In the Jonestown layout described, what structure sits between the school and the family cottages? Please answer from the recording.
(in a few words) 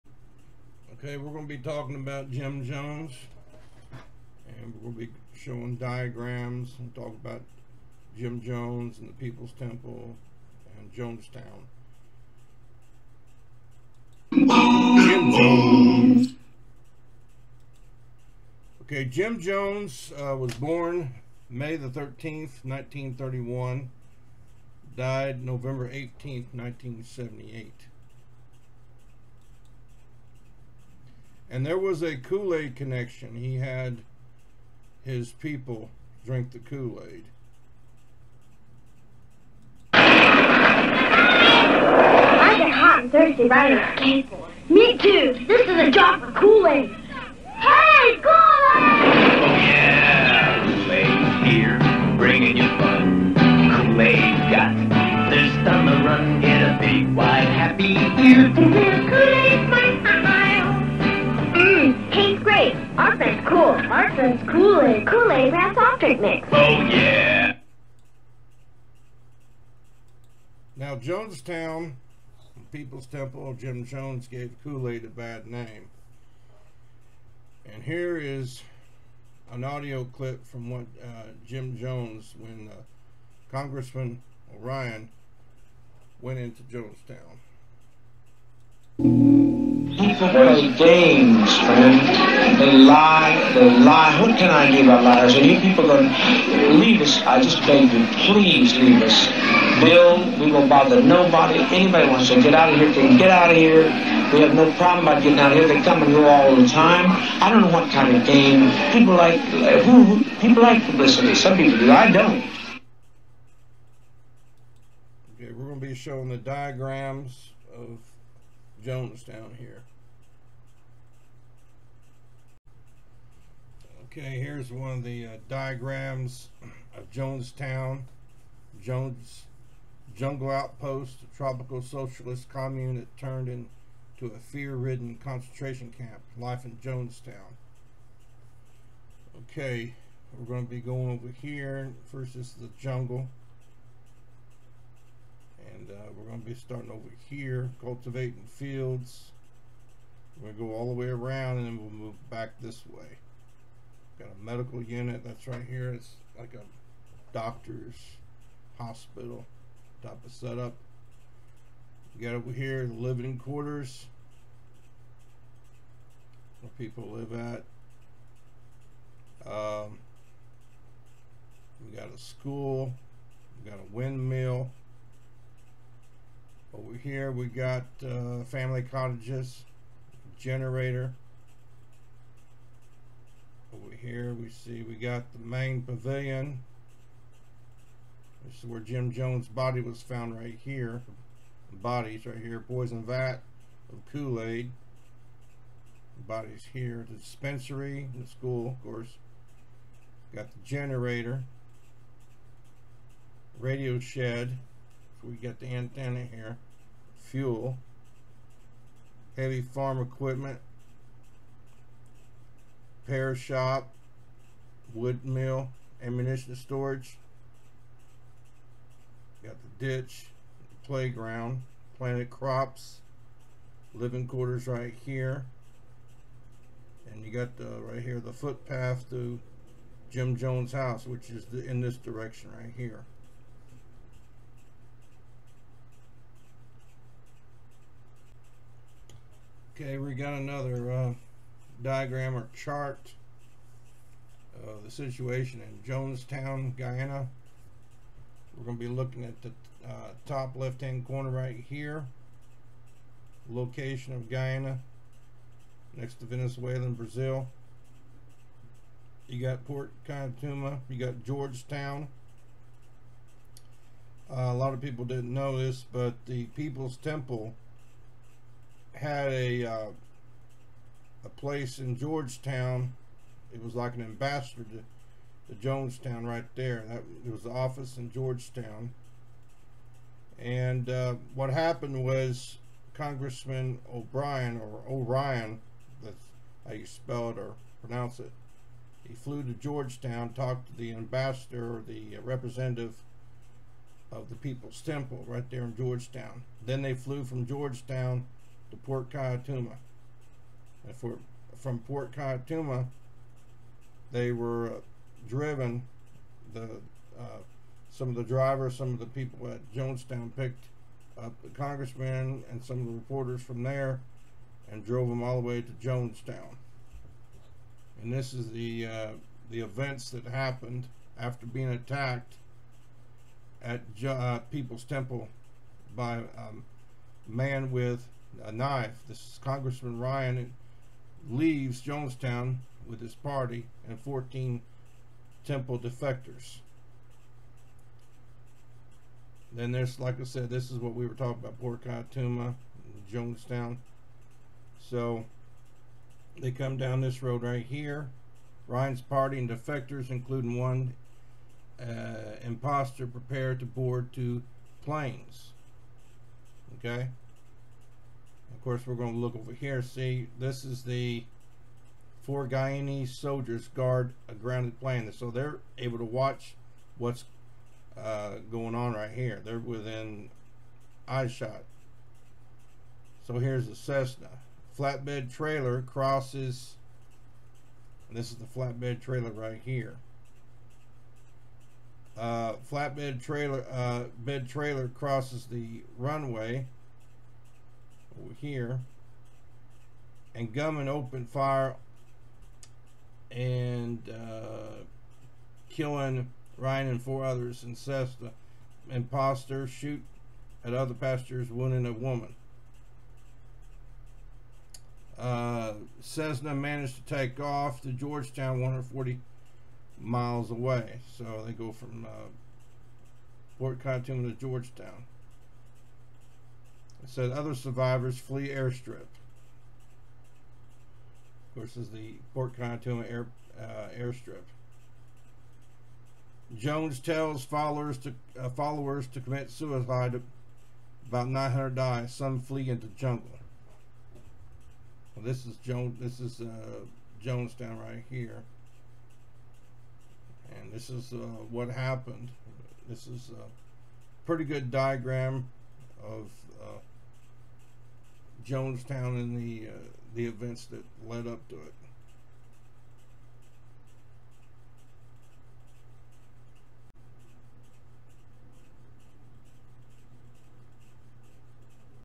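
A windmill.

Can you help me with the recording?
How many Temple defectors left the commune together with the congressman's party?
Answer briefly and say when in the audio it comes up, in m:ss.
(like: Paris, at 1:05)
14, at 5:33.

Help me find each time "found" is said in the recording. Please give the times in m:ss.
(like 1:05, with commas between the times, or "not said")
3:10.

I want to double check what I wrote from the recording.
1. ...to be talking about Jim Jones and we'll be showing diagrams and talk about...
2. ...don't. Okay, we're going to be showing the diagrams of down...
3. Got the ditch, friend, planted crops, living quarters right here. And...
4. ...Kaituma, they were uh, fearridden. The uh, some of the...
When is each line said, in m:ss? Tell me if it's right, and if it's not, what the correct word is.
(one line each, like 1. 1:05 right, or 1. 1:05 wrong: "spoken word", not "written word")
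1. 0:01 right
2. 1:52 right
3. 3:39 wrong: "playground", not "friend"
4. 5:02 wrong: "driven", not "fearridden".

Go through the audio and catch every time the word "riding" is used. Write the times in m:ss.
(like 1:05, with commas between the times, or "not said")
0:43.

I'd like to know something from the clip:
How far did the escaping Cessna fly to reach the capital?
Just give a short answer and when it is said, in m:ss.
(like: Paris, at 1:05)
140 miles, at 6:48.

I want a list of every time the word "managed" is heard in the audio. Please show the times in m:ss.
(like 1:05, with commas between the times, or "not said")
6:46.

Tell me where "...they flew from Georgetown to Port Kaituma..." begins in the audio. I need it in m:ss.
4:56.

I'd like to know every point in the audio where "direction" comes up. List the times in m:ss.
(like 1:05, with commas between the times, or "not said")
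3:51.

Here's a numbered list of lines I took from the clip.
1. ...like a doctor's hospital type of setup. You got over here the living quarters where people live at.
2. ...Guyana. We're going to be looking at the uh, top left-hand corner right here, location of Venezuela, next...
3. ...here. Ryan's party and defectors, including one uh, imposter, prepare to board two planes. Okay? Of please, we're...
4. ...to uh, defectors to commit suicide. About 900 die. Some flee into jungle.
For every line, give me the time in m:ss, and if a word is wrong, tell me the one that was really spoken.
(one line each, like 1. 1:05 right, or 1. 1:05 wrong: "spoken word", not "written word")
1. 2:36 right
2. 4:06 wrong: "Guyana", not "Venezuela"
3. 5:47 wrong: "course", not "please"
4. 7:07 wrong: "followers", not "defectors".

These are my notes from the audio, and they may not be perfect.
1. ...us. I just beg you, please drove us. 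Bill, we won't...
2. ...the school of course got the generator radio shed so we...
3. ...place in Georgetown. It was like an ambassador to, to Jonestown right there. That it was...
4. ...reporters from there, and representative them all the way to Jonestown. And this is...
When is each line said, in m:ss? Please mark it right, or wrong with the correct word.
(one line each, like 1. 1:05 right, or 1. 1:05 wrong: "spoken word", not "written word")
1. 1:37 wrong: "leave", not "drove"
2. 3:18 right
3. 4:31 right
4. 5:12 wrong: "drove", not "representative".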